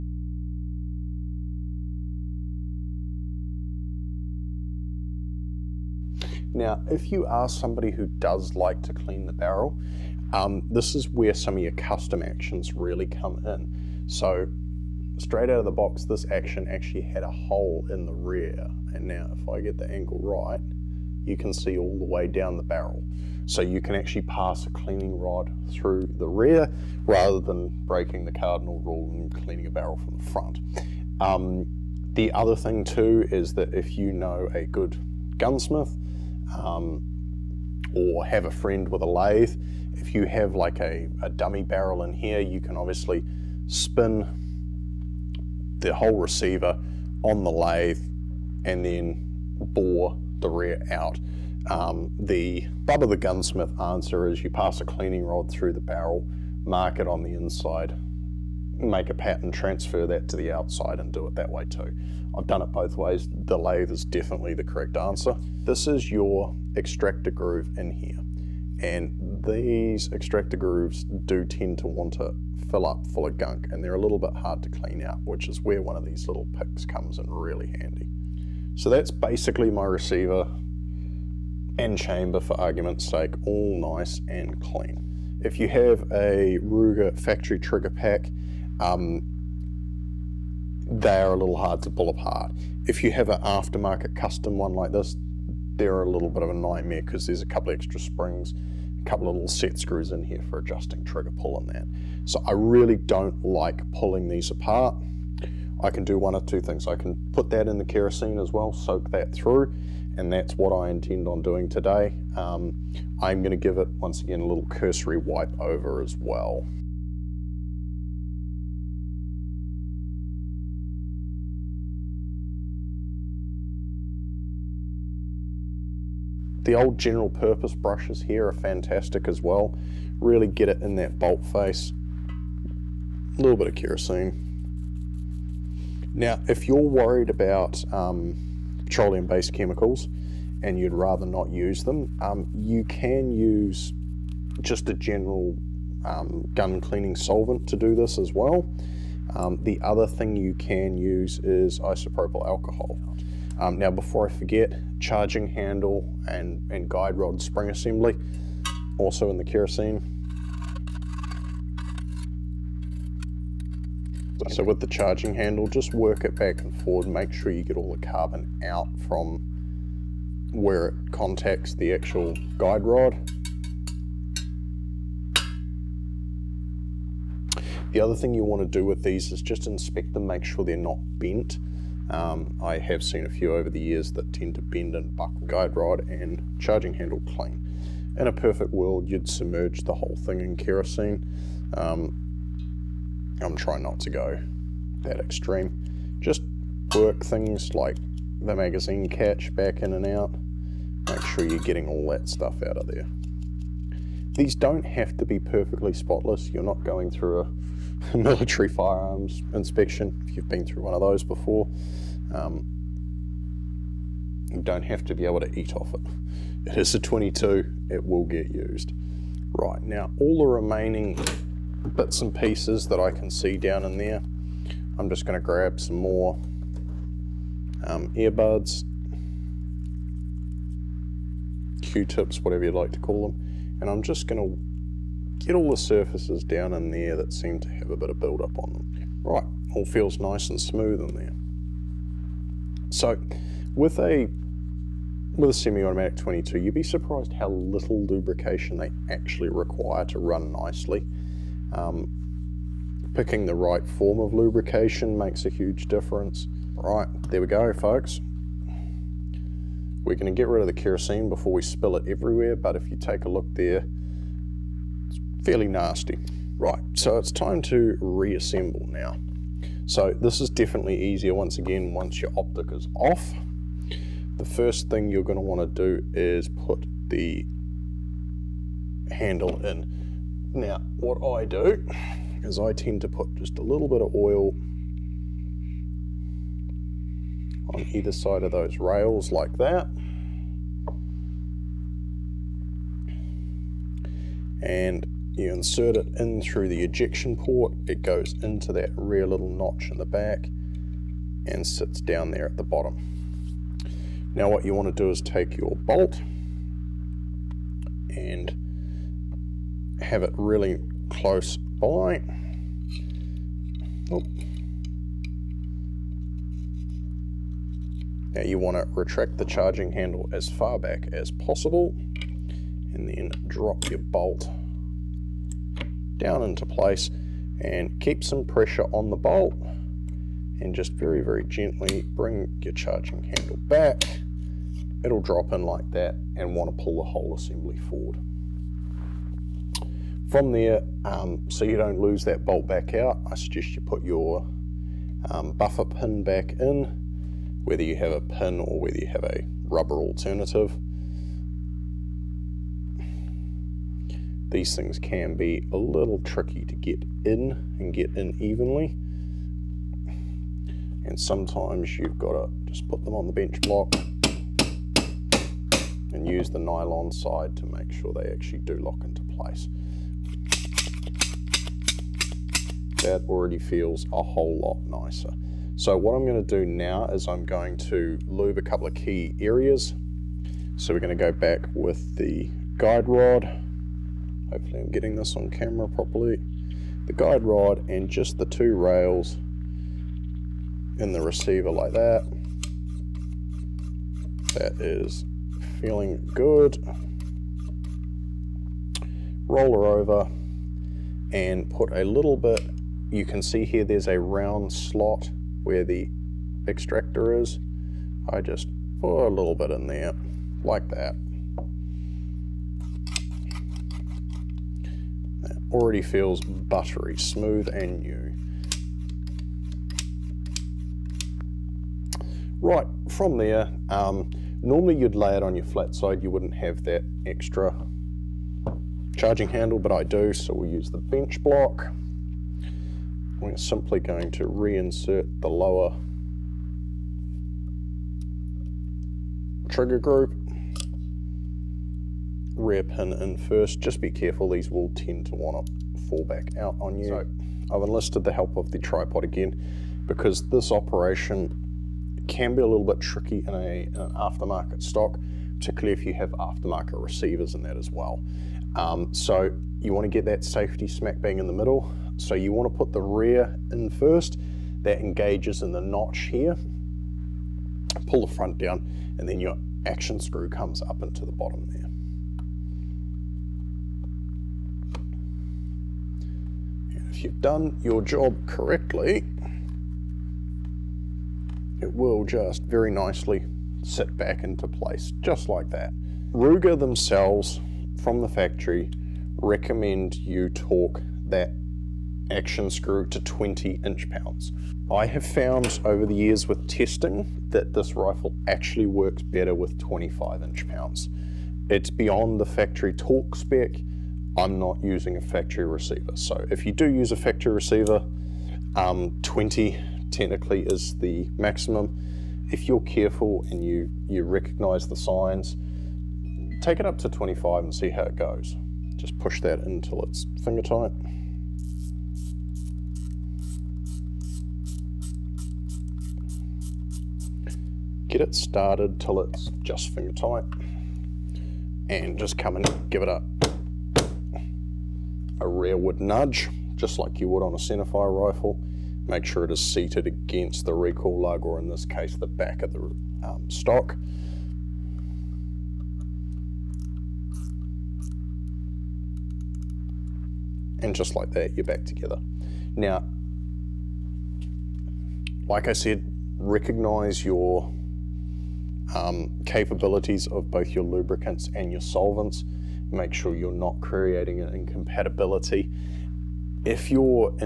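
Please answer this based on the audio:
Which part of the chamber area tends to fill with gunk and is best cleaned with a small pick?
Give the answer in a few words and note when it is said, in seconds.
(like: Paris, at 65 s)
Extractor groove, at 66 s.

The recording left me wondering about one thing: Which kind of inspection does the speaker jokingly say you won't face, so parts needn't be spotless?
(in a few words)
Military firearms inspection.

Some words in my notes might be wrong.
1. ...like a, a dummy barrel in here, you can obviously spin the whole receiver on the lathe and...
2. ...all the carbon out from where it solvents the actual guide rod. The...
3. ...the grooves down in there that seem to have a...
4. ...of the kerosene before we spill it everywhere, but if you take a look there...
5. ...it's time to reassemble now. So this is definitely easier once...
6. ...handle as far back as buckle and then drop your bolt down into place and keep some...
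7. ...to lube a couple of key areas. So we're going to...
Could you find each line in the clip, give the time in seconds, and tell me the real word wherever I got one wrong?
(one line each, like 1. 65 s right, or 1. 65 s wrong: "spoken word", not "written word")
1. 40 s right
2. 167 s wrong: "contacts", not "solvents"
3. 235 s wrong: "surfaces", not "grooves"
4. 260 s right
5. 267 s right
6. 319 s wrong: "possible", not "buckle"
7. 377 s right.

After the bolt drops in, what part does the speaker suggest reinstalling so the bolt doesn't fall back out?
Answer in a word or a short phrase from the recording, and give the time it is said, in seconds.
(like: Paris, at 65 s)
Buffer pin, at 345 s.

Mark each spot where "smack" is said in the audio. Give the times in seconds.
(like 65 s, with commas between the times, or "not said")
460 s.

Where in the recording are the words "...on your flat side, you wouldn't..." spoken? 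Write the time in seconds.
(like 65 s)
425 s.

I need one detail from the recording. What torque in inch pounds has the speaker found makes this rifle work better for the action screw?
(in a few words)
25.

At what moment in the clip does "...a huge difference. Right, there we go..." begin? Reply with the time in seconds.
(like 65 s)
255 s.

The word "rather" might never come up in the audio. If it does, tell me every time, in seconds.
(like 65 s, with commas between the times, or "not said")
27 s, 140 s.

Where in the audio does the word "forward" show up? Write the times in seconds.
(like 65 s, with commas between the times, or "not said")
166 s, 337 s.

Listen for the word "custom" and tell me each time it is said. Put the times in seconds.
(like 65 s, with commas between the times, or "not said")
11 s, 94 s.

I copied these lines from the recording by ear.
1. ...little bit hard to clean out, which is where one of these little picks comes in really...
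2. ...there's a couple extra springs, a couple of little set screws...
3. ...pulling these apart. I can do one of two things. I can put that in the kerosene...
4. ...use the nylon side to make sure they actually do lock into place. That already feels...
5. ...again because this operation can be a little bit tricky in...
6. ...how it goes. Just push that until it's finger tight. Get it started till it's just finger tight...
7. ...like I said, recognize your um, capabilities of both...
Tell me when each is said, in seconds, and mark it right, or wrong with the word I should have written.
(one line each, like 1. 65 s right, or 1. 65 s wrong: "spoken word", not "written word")
1. 74 s right
2. 97 s right
3. 103 s right
4. 366 s right
5. 449 s right
6. 517 s right
7. 555 s right.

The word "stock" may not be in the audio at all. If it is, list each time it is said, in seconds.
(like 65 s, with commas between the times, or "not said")
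454 s, 543 s.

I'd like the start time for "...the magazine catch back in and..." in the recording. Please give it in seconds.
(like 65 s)
198 s.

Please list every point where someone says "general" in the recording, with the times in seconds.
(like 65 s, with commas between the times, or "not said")
126 s, 144 s.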